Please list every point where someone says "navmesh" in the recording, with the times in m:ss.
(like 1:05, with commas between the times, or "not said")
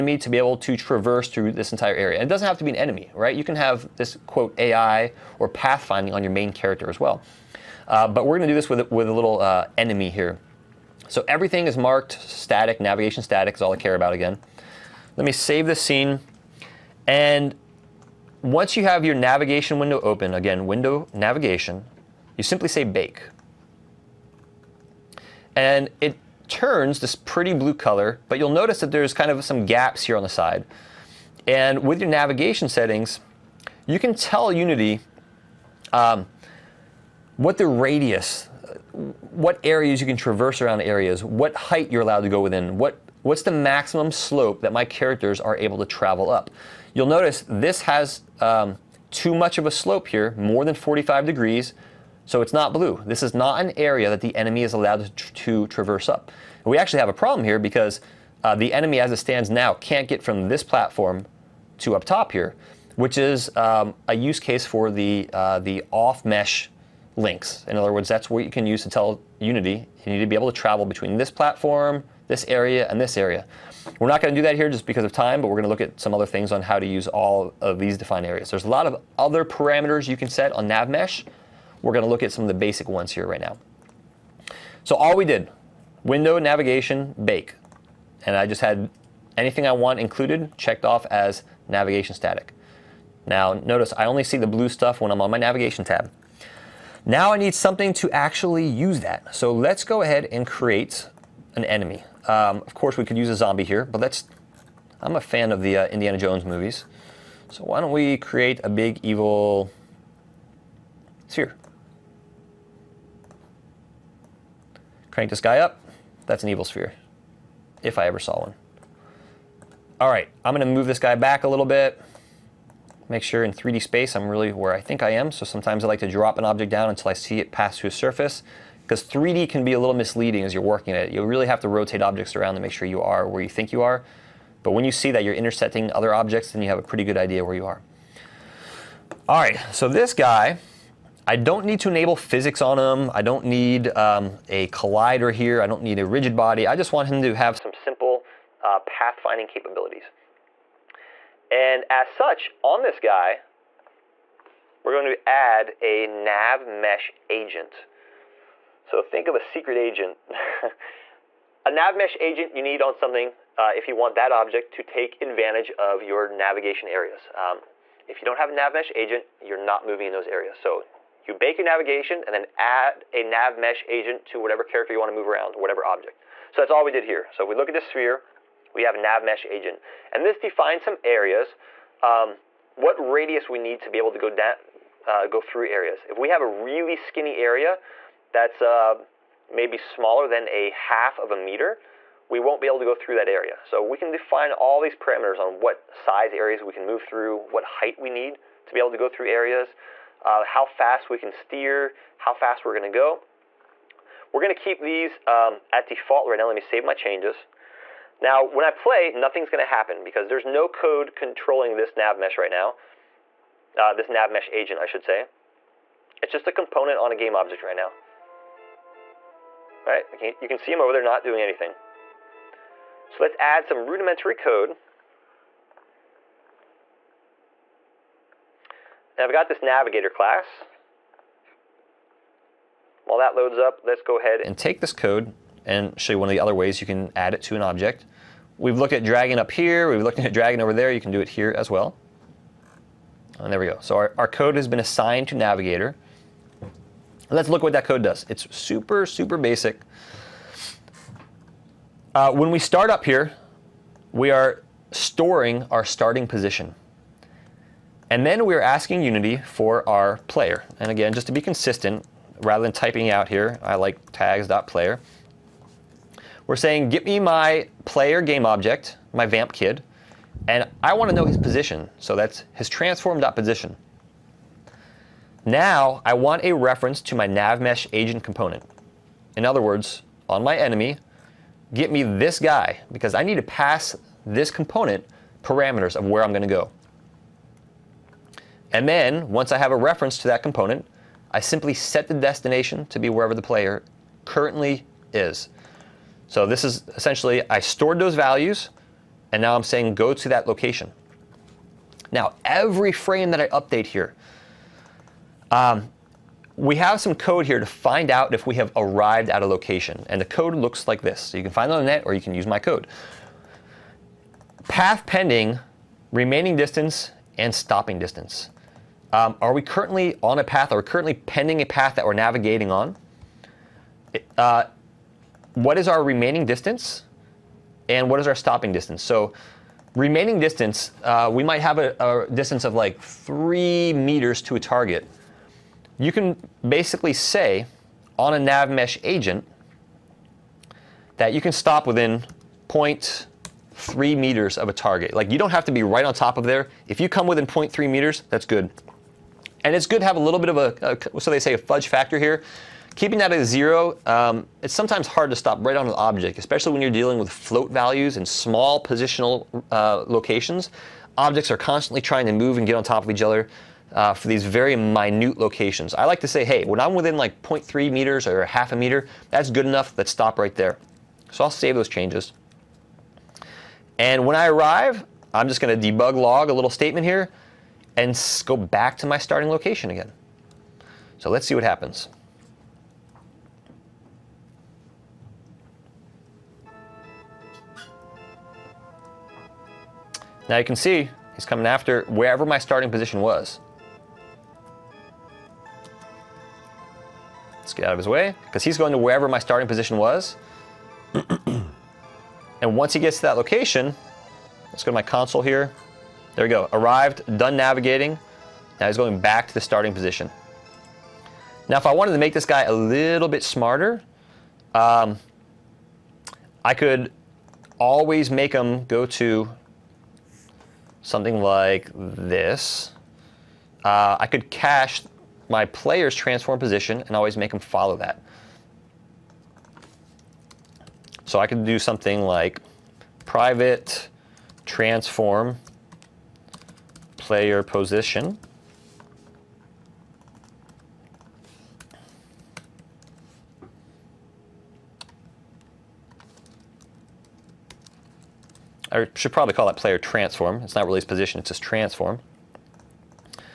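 1:20, 4:37.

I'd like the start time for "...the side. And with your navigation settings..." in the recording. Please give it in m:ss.
0:30.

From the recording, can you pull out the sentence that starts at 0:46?
You'll notice this has um, too much of a slope here, more than 45 degrees, so it's not blue.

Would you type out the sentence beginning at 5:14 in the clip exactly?
Path pending, remaining distance, and stopping distance.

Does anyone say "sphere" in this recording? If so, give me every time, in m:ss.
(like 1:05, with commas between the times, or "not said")
1:51, 1:56, 2:57.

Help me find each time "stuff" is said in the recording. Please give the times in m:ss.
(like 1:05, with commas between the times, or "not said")
1:34.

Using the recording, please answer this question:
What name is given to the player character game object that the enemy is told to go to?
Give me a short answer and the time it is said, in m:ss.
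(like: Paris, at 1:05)
vamp kid, at 4:29.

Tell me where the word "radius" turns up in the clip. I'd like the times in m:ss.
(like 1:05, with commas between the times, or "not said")
0:37, 3:02.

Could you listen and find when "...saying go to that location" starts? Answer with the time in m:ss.
4:59.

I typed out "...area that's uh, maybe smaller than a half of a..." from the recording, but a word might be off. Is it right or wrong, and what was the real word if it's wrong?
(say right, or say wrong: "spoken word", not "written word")
right.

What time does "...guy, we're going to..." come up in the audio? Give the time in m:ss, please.
2:32.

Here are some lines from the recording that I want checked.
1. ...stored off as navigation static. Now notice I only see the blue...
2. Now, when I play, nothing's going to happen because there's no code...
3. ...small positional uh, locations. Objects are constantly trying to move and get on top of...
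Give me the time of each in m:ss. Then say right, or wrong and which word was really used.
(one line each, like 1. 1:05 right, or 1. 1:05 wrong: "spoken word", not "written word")
1. 1:30 wrong: "checked", not "stored"
2. 3:28 right
3. 5:58 right.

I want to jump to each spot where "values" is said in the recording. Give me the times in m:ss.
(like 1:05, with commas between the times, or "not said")
4:58, 5:57.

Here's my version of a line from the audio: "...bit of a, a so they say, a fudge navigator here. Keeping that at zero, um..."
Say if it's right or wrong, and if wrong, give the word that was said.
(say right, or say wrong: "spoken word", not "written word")
wrong: "factor", not "navigator".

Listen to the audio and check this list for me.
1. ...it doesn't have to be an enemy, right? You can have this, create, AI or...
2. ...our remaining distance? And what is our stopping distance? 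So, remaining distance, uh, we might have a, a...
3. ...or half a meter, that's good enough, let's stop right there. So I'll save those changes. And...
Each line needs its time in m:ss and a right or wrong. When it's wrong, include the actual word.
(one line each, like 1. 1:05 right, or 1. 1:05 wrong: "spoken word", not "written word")
1. 0:02 wrong: "quote", not "create"
2. 5:25 right
3. 6:08 right.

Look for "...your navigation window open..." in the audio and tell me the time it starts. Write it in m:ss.
0:19.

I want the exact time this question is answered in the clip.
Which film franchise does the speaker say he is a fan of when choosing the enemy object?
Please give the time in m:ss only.
1:45.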